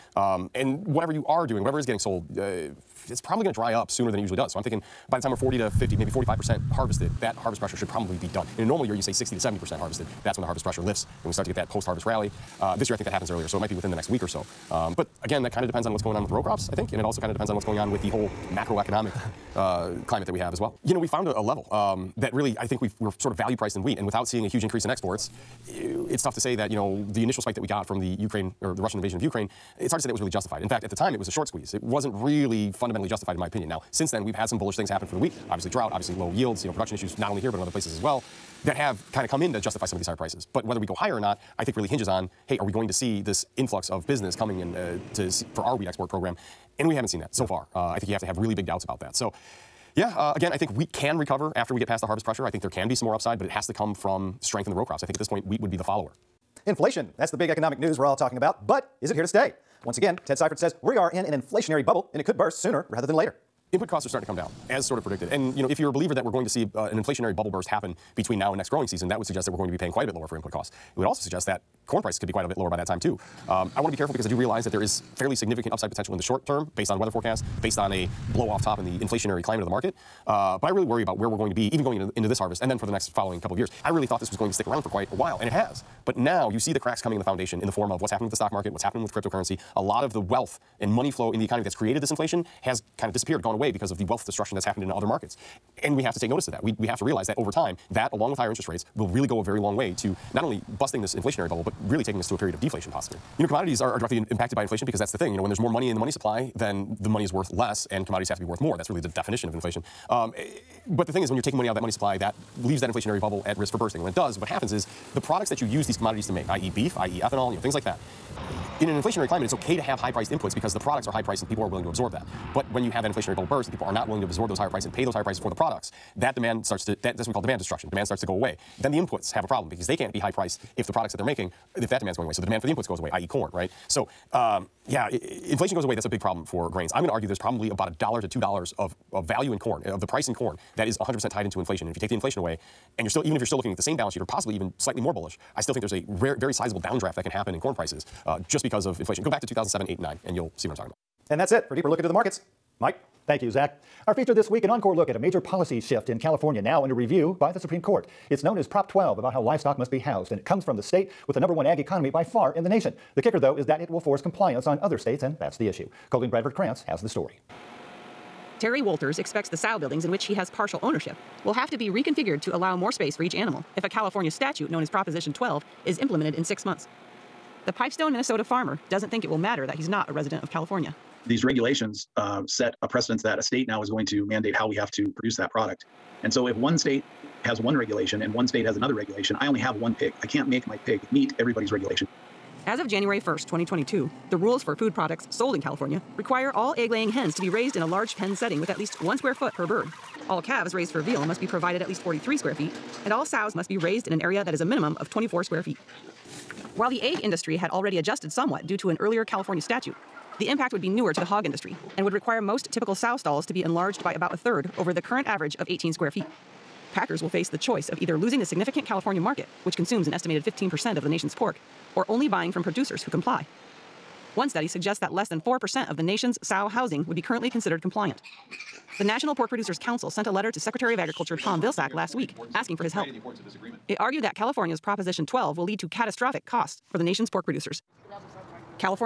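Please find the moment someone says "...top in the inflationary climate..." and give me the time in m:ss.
1:18.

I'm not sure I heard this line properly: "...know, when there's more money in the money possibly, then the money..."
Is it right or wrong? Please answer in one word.
wrong.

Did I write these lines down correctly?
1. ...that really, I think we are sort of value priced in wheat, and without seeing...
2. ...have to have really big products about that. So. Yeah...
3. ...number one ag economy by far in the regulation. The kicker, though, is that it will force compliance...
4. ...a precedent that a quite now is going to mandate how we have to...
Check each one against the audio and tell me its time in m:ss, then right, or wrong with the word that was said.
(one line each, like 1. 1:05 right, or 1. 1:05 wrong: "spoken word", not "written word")
1. 0:22 right
2. 0:48 wrong: "doubts", not "products"
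3. 2:41 wrong: "nation", not "regulation"
4. 3:02 wrong: "state", not "quite".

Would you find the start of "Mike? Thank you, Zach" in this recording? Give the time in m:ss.
2:32.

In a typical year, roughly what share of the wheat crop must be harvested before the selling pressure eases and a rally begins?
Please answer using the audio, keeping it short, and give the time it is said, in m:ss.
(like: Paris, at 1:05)
60 to 70%, at 0:09.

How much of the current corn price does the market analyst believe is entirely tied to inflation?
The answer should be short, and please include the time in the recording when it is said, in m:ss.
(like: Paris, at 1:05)
$1 to $2, at 2:17.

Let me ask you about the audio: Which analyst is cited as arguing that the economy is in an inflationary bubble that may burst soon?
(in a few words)
Ted Seifert.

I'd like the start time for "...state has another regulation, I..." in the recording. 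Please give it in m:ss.
3:08.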